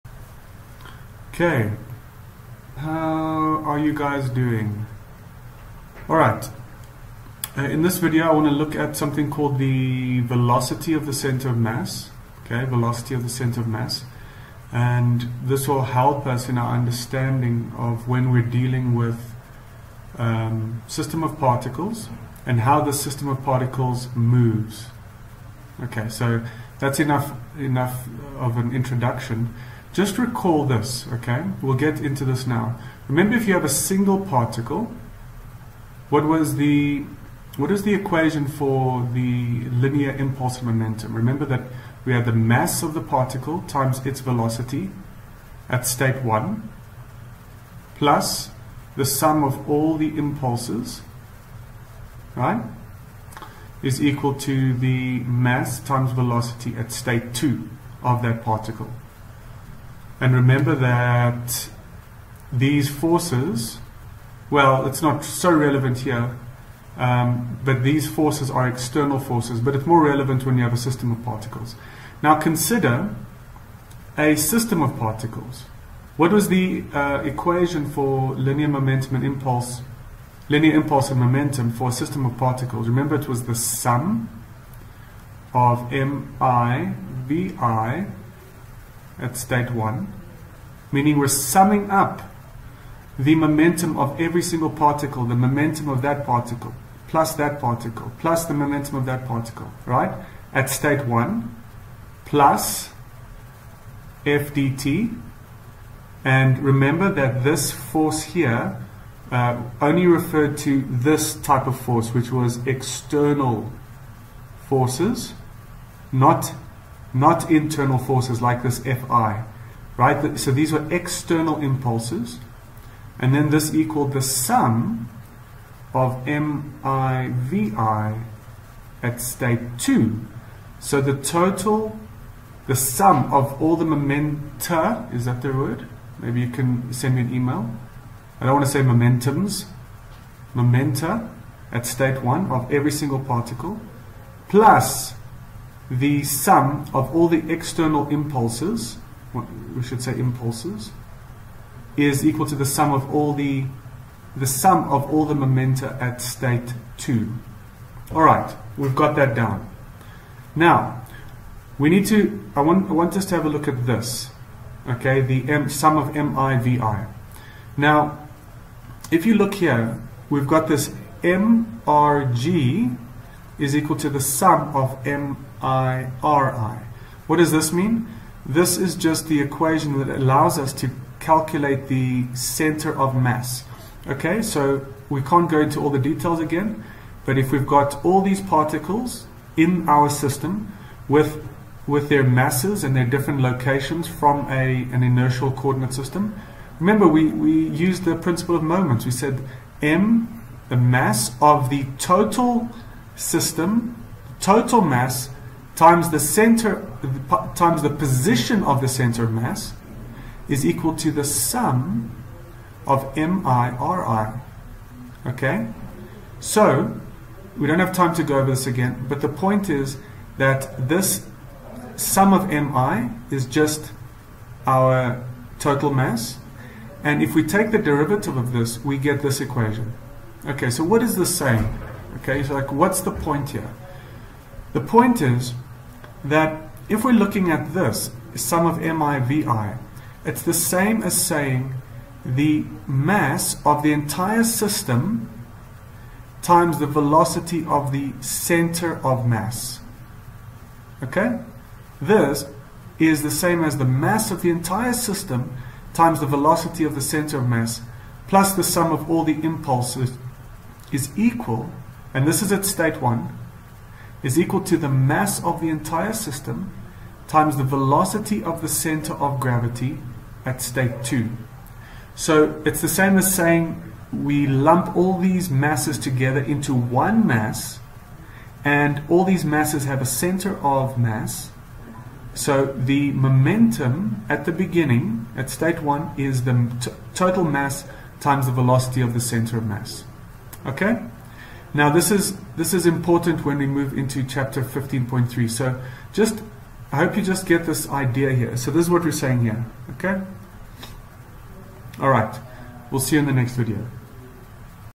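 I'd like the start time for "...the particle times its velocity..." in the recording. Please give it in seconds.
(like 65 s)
42 s.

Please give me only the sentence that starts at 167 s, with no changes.
Now, if you look here, we've got this MRG is equal to the sum of MIRI.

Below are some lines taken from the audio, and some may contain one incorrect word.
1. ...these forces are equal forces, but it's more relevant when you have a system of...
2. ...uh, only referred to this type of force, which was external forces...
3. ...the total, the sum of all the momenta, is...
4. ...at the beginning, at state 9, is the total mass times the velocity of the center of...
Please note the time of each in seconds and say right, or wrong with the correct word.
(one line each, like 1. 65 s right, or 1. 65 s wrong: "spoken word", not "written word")
1. 67 s wrong: "external", not "equal"
2. 109 s right
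3. 131 s right
4. 284 s wrong: "1", not "9".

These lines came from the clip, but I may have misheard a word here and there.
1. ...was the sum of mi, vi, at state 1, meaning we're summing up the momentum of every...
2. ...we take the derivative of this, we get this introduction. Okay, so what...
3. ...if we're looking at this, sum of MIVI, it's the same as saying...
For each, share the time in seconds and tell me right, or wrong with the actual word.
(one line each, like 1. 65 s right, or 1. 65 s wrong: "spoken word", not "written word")
1. 83 s right
2. 227 s wrong: "equation", not "introduction"
3. 236 s right.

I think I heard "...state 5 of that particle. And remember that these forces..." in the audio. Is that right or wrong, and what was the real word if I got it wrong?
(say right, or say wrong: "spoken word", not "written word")
wrong: "2", not "5".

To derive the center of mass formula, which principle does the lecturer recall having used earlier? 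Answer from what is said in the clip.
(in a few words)
Principle of moments.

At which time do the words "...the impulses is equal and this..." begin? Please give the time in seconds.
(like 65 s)
259 s.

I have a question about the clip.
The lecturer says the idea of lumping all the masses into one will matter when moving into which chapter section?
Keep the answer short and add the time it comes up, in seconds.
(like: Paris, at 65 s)
15.3, at 294 s.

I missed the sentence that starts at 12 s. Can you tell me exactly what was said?
Okay, velocity of the center of mass.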